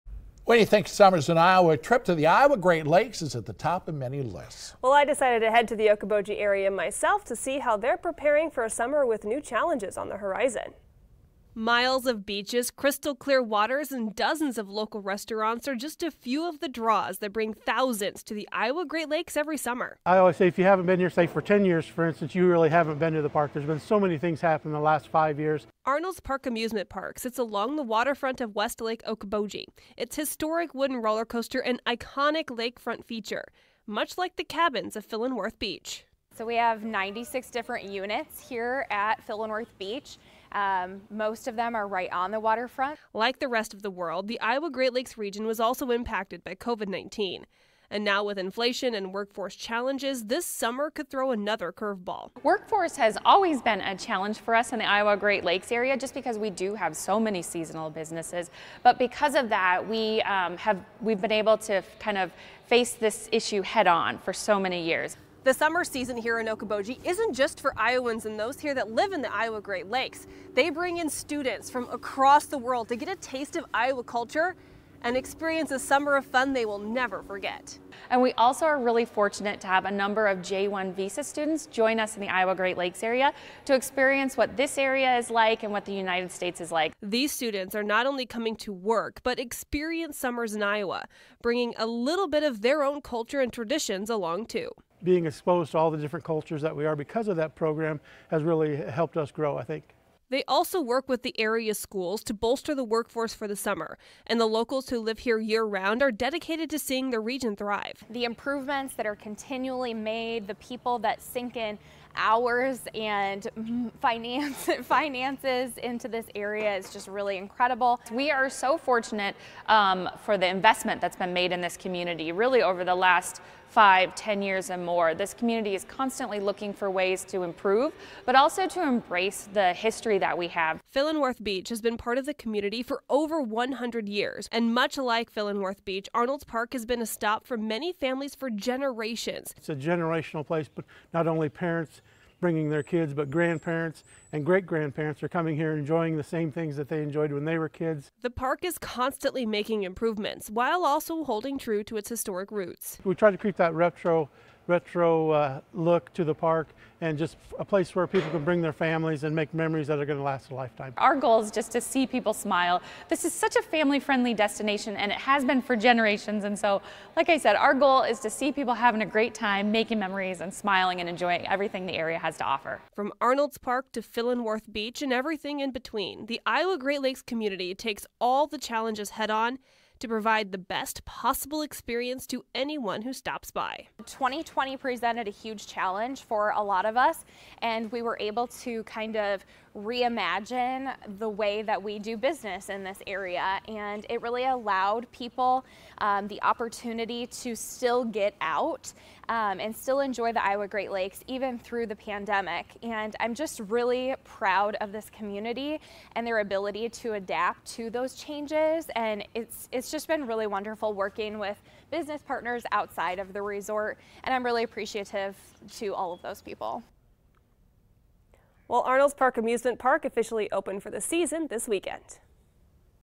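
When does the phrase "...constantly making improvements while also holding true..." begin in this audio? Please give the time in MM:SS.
02:28.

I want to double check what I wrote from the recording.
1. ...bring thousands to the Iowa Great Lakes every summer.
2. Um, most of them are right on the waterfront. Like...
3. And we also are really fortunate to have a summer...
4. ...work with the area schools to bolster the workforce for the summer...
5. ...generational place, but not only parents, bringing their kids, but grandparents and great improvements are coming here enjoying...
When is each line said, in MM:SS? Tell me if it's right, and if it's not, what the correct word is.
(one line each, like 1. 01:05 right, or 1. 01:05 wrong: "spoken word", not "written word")
1. 00:17 right
2. 00:40 right
3. 01:18 wrong: "number", not "summer"
4. 01:40 right
5. 02:19 wrong: "grandparents", not "improvements".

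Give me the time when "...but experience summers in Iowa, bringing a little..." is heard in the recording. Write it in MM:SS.
01:29.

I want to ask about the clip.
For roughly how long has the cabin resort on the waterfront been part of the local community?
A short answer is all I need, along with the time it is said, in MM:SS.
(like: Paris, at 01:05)
over 100 years, at 02:13.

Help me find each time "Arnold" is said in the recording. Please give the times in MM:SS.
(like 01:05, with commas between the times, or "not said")
00:25, 02:16, 02:53, 03:38.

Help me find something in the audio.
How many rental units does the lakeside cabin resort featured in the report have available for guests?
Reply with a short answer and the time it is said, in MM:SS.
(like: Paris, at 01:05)
96, at 00:36.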